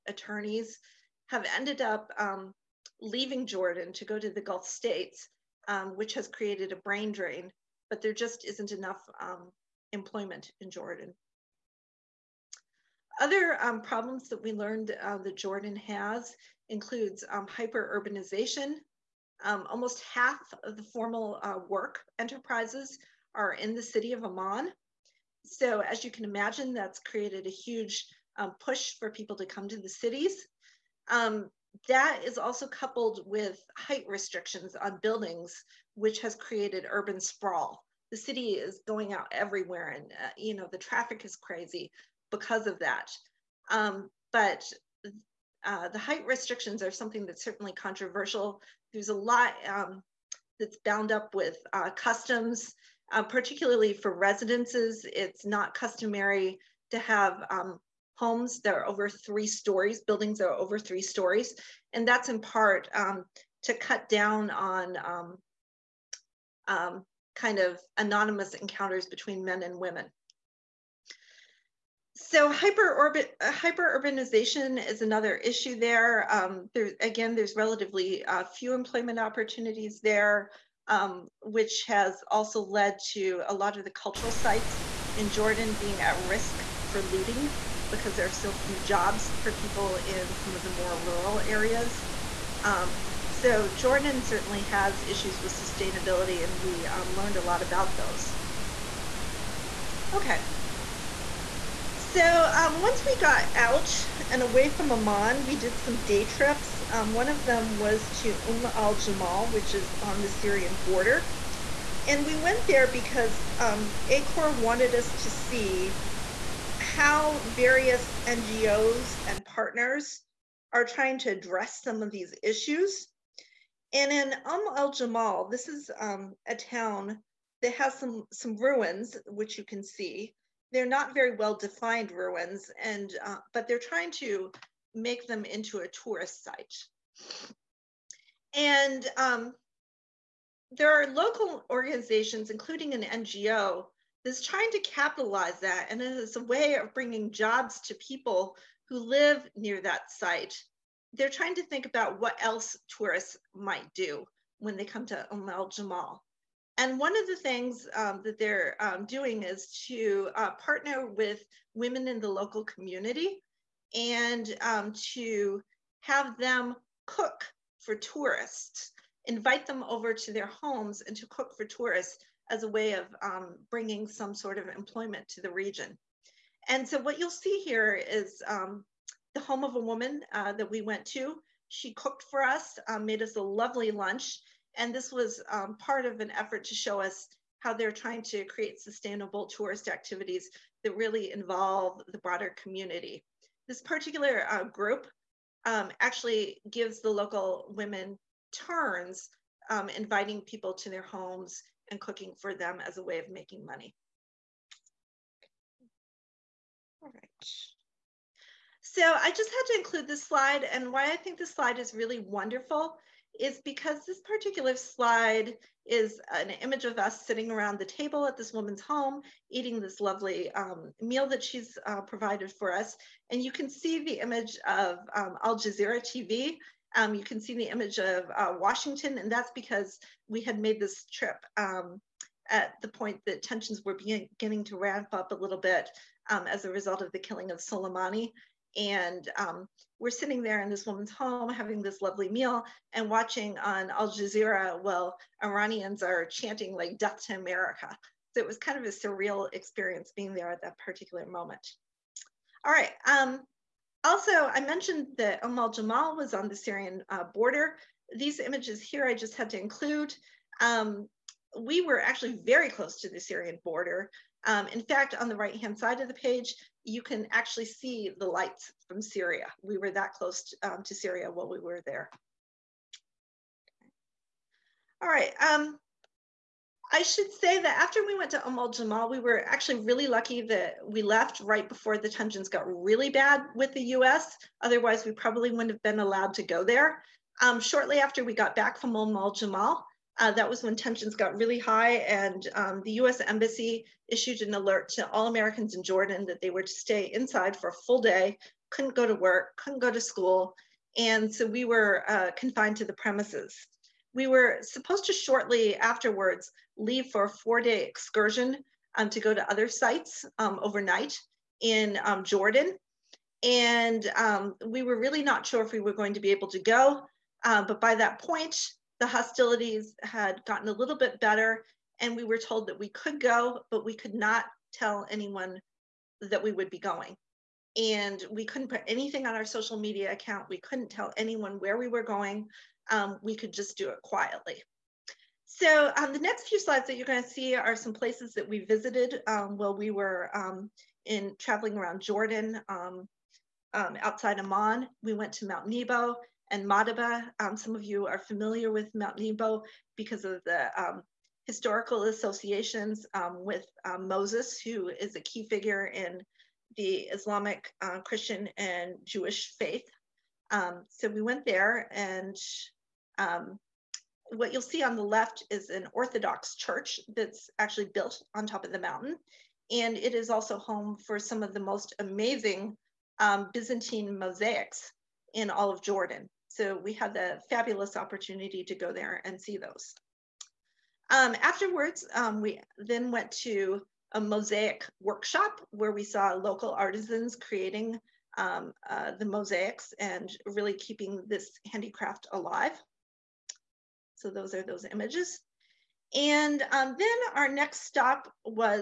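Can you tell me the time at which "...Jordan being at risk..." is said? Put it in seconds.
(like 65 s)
85 s.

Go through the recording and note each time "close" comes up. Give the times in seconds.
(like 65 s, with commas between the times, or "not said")
262 s, 270 s.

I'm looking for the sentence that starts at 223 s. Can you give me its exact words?
And you can see the image of um, Al Jazeera TV.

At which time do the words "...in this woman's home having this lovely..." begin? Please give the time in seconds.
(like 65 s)
240 s.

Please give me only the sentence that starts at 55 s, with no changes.
It's not customary to have um, homes that are over three stories, buildings that are over three stories.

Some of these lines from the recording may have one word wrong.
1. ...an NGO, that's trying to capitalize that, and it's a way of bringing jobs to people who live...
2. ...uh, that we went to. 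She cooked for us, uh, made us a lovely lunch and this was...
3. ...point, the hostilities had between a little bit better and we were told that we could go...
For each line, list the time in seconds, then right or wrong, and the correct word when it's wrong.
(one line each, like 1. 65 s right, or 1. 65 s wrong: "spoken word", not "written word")
1. 142 s right
2. 180 s right
3. 318 s wrong: "gotten", not "between".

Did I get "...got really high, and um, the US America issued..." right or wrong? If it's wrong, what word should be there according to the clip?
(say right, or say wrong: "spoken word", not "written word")
wrong: "Embassy", not "America".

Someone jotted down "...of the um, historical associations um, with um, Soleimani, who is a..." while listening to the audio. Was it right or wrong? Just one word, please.
wrong.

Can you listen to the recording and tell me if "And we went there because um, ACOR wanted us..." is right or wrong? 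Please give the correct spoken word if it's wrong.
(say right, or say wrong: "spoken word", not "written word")
right.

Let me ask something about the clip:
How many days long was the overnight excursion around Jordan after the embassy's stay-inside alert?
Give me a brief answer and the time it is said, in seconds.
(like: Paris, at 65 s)
4, at 307 s.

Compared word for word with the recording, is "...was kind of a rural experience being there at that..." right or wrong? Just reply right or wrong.
wrong.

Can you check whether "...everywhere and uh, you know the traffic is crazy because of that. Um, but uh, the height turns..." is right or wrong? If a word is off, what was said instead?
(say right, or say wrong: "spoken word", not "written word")
wrong: "restrictions", not "turns".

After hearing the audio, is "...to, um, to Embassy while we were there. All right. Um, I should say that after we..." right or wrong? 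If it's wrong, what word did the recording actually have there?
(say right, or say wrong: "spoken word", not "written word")
wrong: "Syria", not "Embassy".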